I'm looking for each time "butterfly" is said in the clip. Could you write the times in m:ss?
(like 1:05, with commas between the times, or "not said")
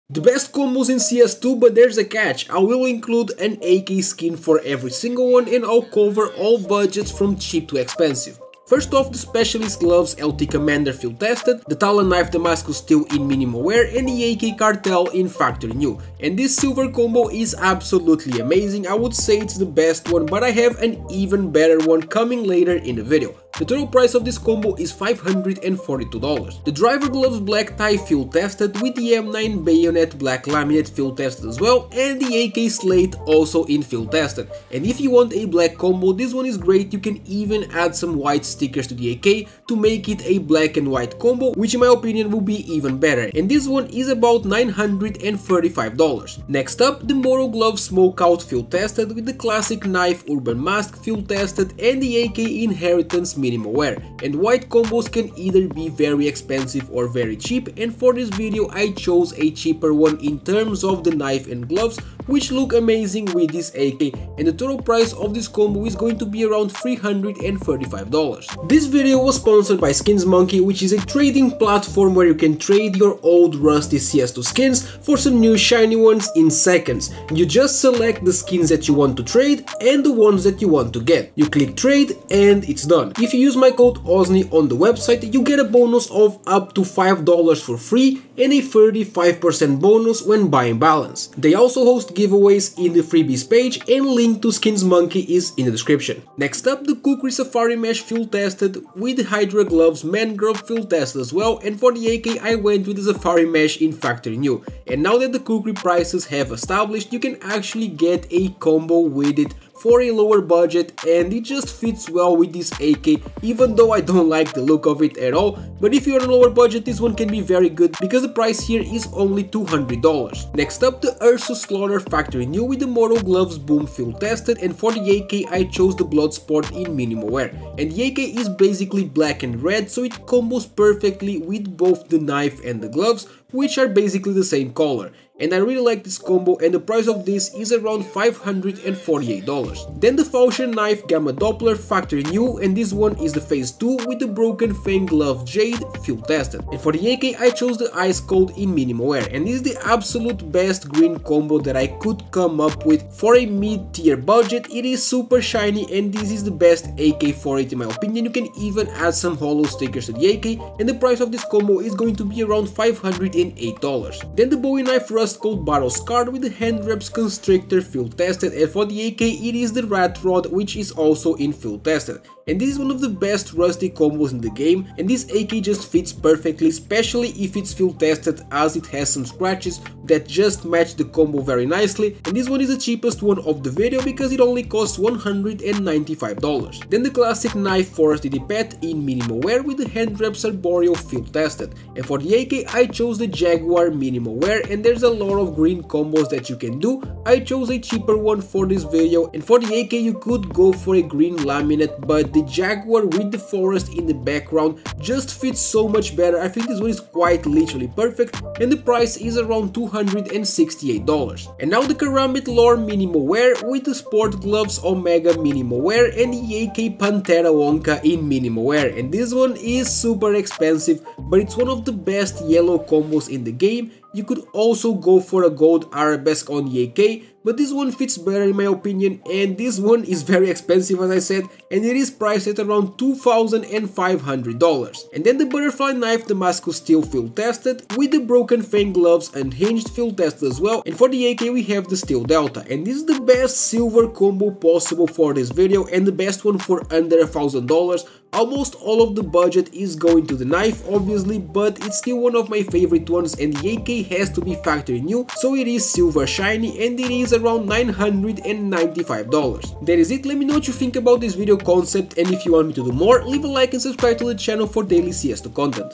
3:55.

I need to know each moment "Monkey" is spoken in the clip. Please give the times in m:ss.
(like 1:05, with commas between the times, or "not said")
1:10, 1:34.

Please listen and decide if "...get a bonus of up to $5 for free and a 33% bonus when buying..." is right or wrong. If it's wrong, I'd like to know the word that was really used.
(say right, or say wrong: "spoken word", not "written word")
wrong: "35", not "33".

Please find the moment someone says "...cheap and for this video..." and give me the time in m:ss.
0:57.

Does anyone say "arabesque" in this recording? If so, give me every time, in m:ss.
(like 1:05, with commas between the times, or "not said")
3:45.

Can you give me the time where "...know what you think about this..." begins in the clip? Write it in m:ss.
4:20.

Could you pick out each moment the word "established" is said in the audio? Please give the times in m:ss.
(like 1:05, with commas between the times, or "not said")
1:46.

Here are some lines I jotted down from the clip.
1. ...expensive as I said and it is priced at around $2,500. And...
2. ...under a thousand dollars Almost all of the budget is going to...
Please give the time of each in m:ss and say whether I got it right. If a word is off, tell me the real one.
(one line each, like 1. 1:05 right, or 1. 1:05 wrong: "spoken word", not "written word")
1. 3:50 right
2. 4:06 right.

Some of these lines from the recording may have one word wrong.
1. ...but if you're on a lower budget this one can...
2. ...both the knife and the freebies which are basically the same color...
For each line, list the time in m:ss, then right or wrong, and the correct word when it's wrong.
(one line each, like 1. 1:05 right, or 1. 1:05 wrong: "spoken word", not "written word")
1. 1:55 right
2. 2:11 wrong: "gloves", not "freebies".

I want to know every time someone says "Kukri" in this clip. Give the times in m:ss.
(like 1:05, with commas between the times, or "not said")
1:36, 1:45.